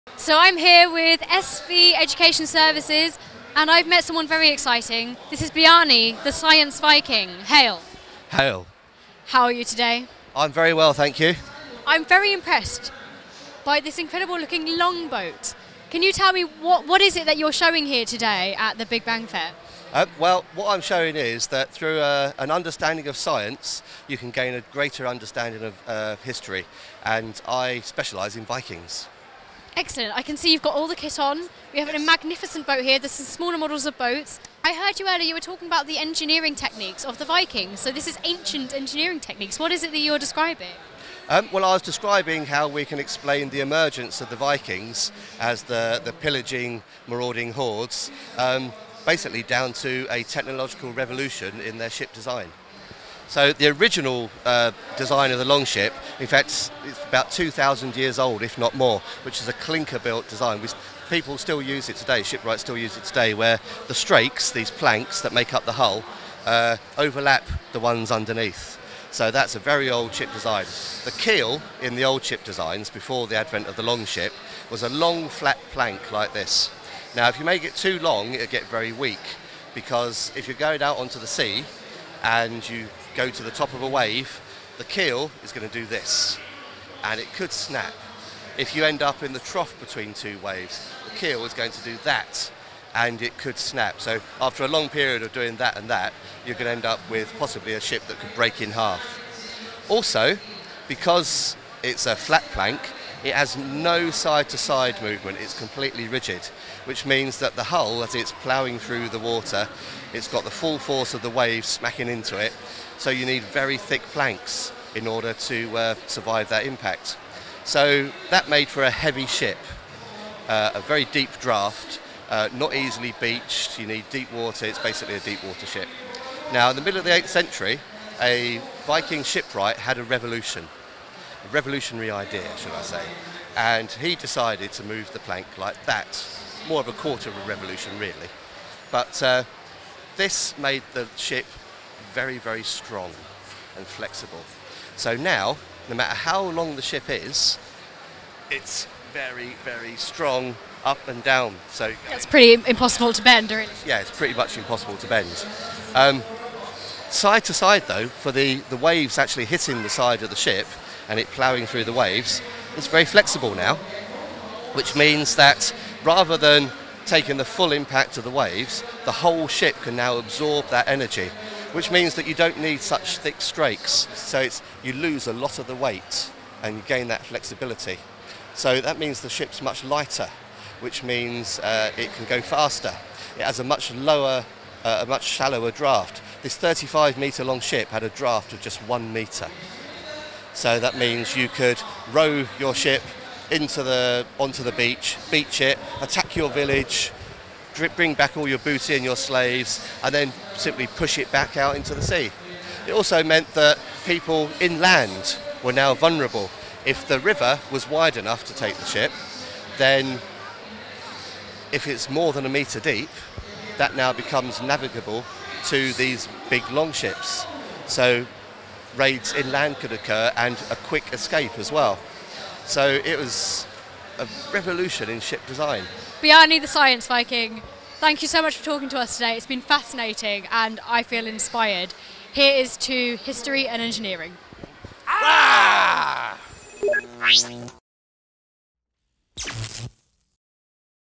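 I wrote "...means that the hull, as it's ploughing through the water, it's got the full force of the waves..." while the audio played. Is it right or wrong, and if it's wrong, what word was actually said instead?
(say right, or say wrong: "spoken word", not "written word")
right.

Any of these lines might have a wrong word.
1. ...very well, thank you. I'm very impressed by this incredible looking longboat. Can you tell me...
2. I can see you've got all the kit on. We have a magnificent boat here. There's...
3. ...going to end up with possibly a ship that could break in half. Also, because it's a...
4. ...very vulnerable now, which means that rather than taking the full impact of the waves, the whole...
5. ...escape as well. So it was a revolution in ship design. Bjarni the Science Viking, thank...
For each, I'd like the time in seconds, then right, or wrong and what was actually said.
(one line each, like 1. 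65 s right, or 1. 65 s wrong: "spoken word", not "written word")
1. 10 s right
2. 30 s right
3. 96 s right
4. 162 s wrong: "flexible", not "vulnerable"
5. 221 s right.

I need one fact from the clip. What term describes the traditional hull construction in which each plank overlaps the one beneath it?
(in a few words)
clinker-built.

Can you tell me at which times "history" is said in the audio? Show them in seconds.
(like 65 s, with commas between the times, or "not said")
26 s, 233 s.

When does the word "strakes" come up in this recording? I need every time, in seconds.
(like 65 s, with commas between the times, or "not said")
63 s, 173 s.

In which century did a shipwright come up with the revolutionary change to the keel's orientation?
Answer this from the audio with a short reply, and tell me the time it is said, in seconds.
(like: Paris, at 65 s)
8th century, at 127 s.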